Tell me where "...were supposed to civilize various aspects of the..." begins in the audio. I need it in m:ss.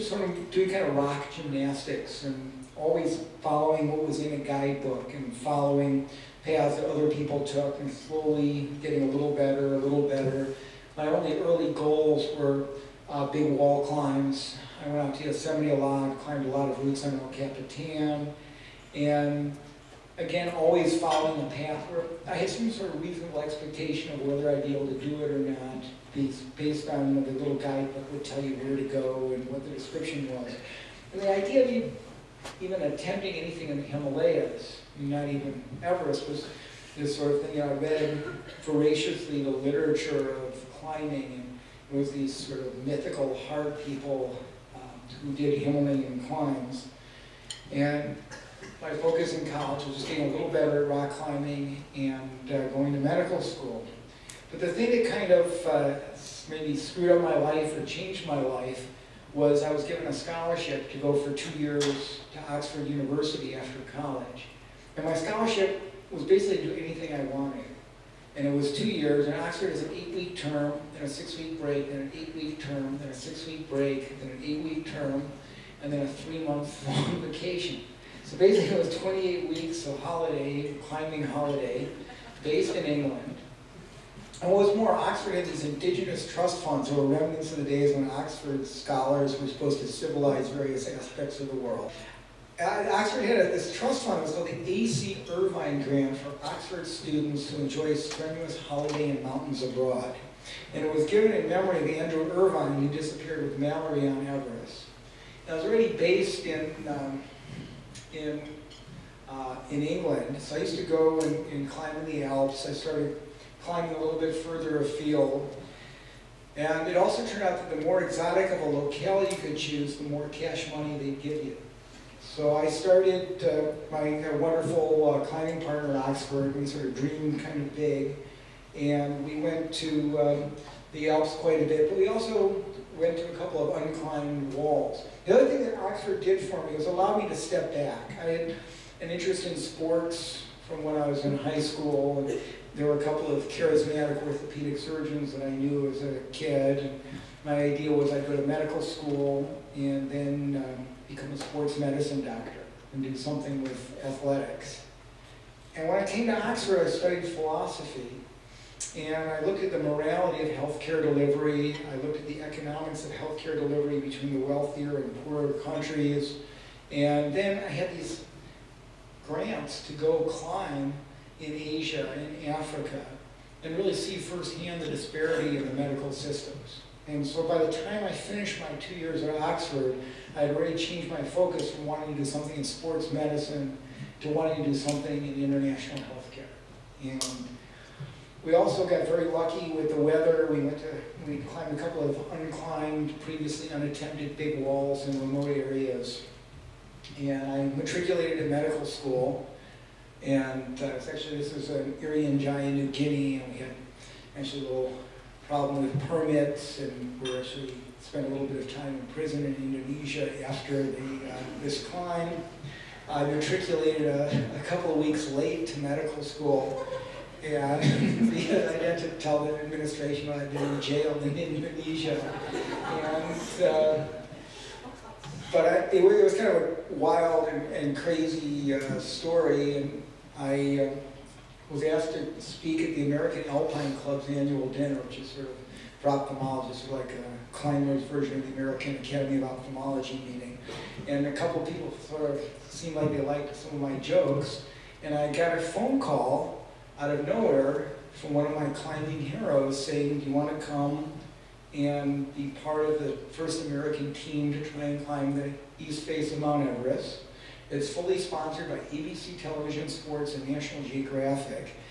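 1:29.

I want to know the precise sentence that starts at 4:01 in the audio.
And a couple people sort of seemed like they liked some of my jokes.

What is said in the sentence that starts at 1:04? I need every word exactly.
And my scholarship was basically to do anything I wanted.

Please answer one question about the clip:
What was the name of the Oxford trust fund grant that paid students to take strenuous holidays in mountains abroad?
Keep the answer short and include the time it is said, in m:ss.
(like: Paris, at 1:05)
A.C. Irvine Grant, at 1:34.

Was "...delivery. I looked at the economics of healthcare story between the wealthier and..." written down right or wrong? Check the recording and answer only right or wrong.
wrong.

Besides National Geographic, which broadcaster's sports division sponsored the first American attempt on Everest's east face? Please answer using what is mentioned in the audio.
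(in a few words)
ABC Television Sports.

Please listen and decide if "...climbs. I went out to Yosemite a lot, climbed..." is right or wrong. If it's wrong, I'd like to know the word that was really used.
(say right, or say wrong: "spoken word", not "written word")
right.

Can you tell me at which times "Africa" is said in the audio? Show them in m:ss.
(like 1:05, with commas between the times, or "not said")
2:52.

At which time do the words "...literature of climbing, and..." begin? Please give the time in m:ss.
0:39.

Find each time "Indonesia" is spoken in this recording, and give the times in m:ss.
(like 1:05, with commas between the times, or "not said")
3:29, 3:41.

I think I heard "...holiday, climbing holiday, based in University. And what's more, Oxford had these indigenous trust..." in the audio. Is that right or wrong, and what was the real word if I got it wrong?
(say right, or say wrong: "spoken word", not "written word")
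wrong: "England", not "University".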